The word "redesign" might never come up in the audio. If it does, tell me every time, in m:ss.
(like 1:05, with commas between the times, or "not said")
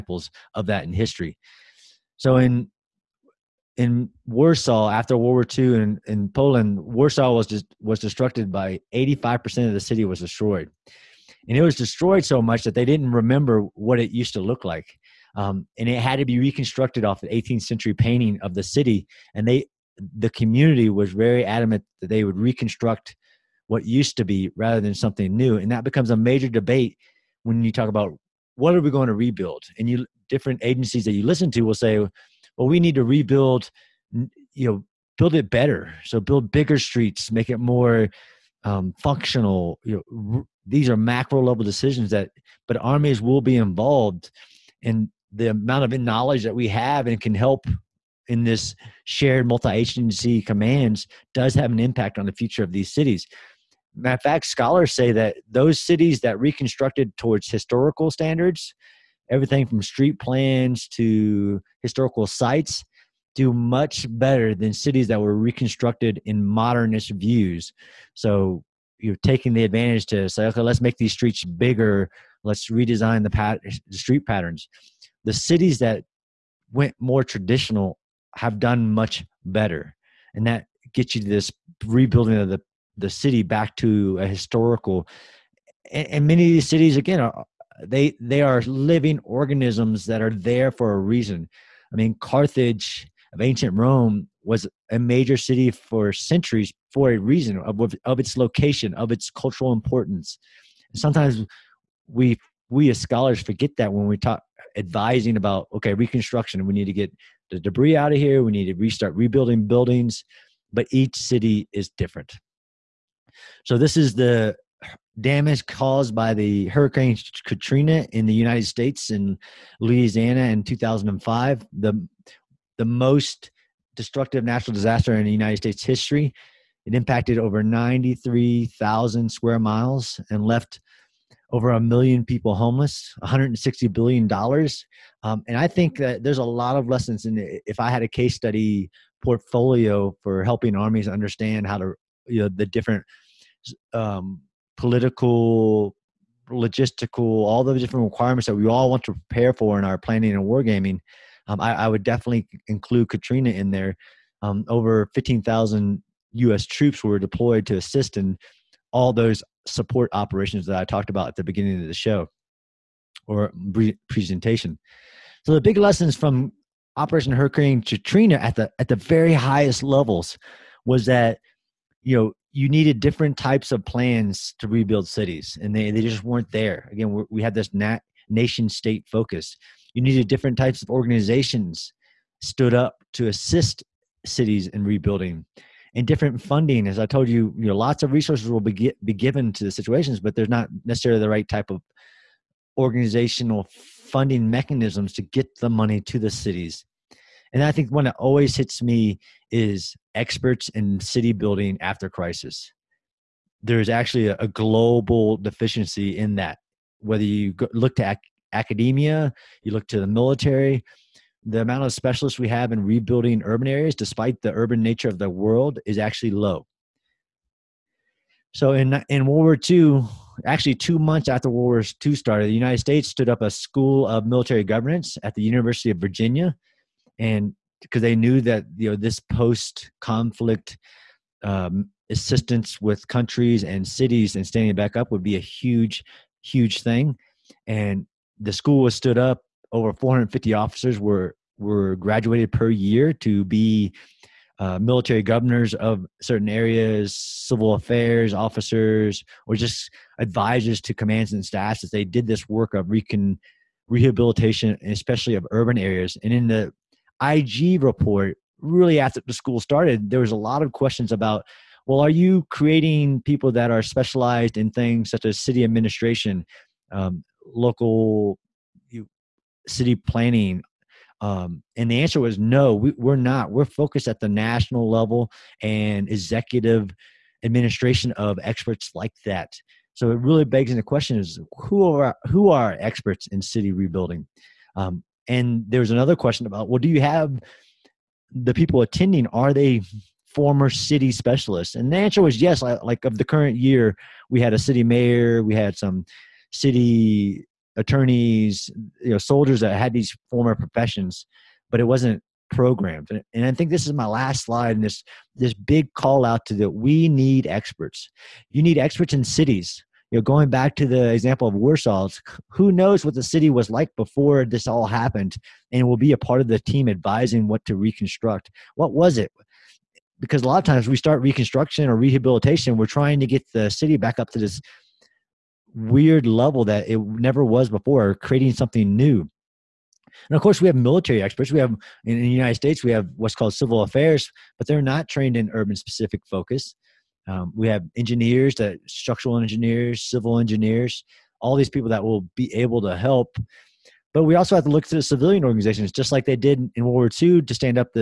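1:12.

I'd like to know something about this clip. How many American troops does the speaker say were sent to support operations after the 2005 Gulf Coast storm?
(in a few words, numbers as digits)
15,000.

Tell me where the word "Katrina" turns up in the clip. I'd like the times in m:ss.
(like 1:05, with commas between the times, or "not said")
1:57, 2:33, 2:47.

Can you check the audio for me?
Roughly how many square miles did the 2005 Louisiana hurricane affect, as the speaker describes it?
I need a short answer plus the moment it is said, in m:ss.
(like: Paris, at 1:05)
93,000, at 2:07.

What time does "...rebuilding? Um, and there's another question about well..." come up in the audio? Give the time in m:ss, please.
4:43.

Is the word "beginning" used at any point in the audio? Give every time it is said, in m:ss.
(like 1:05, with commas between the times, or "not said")
2:41.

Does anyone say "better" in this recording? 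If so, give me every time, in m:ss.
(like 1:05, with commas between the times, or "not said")
0:35, 1:04, 1:19.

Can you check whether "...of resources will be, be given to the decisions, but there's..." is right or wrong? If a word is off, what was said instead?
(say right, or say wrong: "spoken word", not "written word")
wrong: "situations", not "decisions".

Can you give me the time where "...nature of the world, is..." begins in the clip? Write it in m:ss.
3:34.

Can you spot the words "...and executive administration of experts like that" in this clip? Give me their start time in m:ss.
4:35.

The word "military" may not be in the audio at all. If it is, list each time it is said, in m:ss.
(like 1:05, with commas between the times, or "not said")
3:30, 3:44, 4:04, 5:30.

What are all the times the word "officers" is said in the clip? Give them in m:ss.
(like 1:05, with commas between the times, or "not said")
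4:00, 4:08.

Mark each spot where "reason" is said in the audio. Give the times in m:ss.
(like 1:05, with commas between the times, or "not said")
1:30, 1:37.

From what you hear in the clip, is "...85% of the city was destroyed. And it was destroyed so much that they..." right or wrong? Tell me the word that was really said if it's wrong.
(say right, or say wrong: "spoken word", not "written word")
right.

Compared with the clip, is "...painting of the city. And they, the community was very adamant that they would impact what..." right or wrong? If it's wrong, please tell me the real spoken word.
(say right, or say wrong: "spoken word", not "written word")
wrong: "reconstruct", not "impact".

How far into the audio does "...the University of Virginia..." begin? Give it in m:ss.
3:45.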